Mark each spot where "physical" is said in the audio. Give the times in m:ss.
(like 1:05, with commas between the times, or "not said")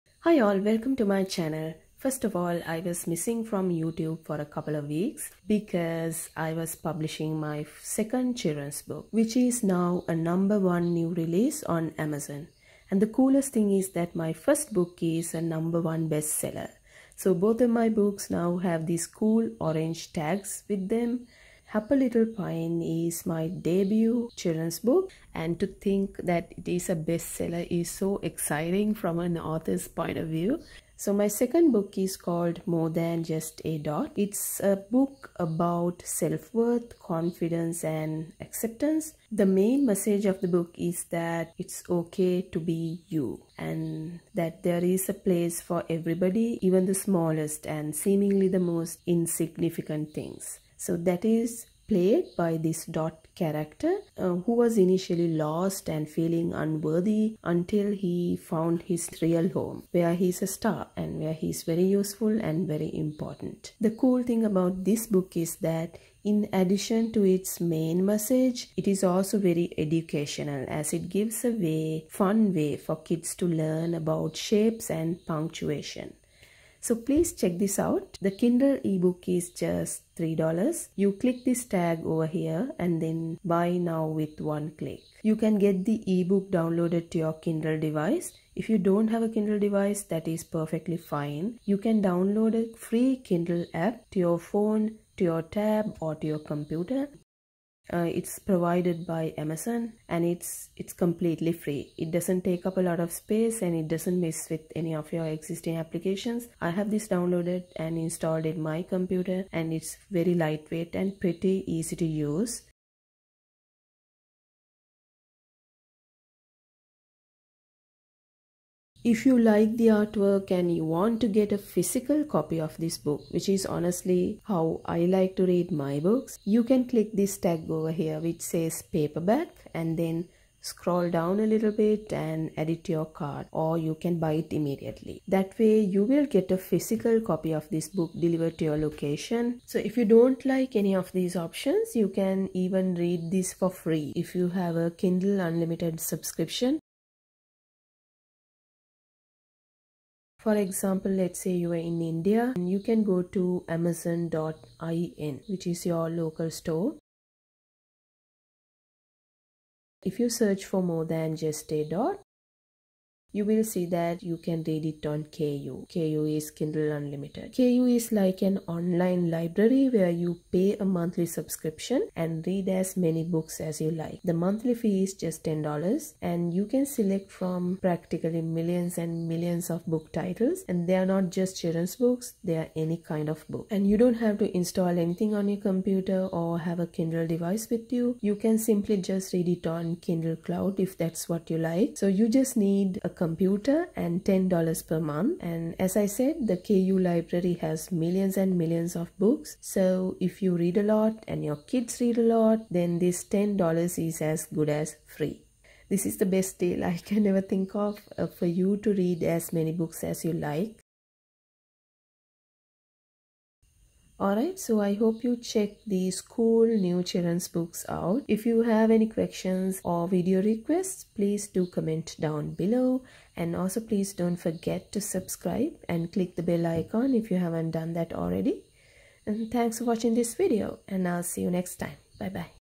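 2:01, 2:16.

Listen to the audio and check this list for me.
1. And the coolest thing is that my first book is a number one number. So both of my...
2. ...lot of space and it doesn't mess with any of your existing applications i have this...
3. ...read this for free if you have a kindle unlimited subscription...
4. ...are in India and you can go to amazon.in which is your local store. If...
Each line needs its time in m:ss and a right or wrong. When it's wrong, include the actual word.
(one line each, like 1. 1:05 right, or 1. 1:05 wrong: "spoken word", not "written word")
1. 0:12 wrong: "bestseller", not "number"
2. 1:42 right
3. 2:22 right
4. 2:31 right.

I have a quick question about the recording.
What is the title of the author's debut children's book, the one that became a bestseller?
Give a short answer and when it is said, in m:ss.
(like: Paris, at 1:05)
Happy Little Pine, at 0:21.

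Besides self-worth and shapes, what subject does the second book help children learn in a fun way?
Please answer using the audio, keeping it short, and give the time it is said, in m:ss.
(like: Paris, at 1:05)
Punctuation, at 1:15.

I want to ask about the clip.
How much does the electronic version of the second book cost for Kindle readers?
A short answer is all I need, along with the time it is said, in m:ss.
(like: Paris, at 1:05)
$3, at 1:20.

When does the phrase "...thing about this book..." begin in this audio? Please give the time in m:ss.
1:04.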